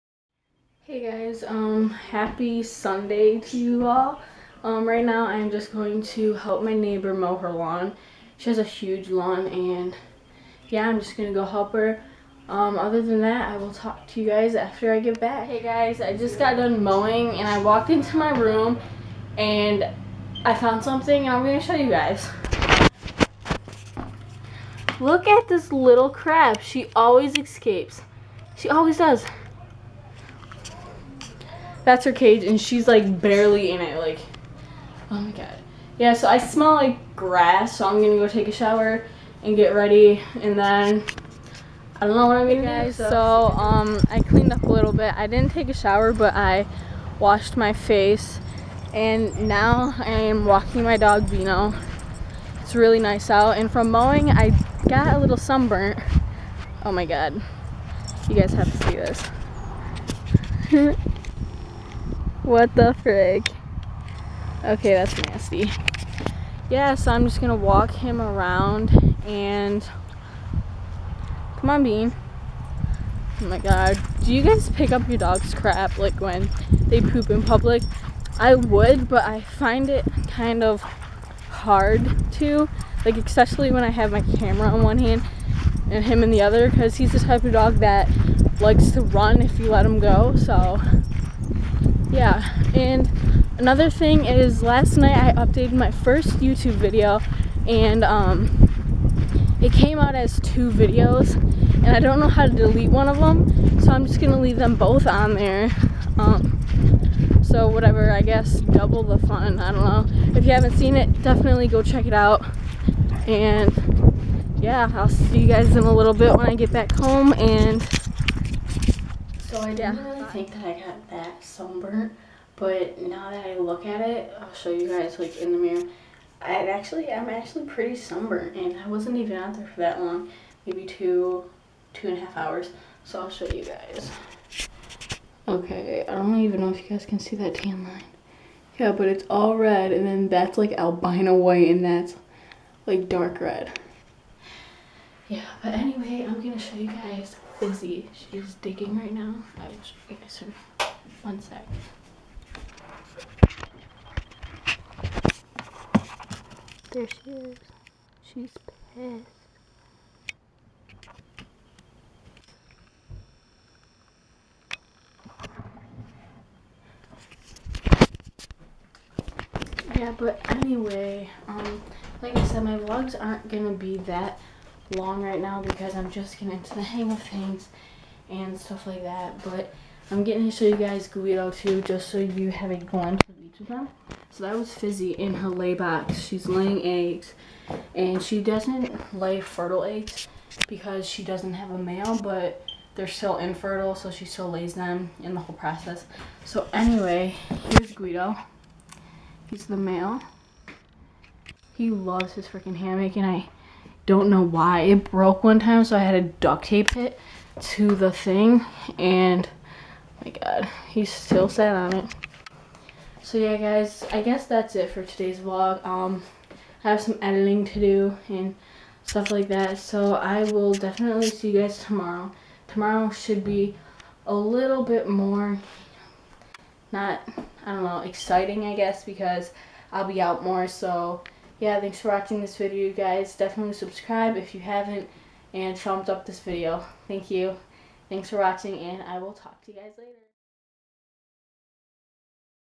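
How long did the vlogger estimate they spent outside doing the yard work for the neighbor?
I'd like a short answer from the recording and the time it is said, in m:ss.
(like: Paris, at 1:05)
2 and a half hours, at 2:11.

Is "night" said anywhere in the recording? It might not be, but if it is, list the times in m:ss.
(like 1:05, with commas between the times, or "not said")
1:34.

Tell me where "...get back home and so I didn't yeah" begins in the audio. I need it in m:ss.
1:56.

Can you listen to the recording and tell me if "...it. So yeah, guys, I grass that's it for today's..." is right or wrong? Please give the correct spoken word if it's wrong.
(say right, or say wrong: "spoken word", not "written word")
wrong: "guess", not "grass".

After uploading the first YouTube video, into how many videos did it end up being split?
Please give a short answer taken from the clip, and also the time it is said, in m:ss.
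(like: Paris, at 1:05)
2, at 1:40.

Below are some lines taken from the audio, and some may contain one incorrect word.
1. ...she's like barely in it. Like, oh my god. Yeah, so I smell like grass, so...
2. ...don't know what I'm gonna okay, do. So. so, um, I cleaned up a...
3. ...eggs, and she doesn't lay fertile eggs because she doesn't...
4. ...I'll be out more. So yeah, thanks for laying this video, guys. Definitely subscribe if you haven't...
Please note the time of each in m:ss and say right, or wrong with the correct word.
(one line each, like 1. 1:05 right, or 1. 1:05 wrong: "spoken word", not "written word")
1. 0:32 right
2. 0:42 right
3. 3:06 right
4. 3:49 wrong: "watching", not "laying".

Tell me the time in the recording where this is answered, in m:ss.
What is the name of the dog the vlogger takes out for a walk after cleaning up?
0:51.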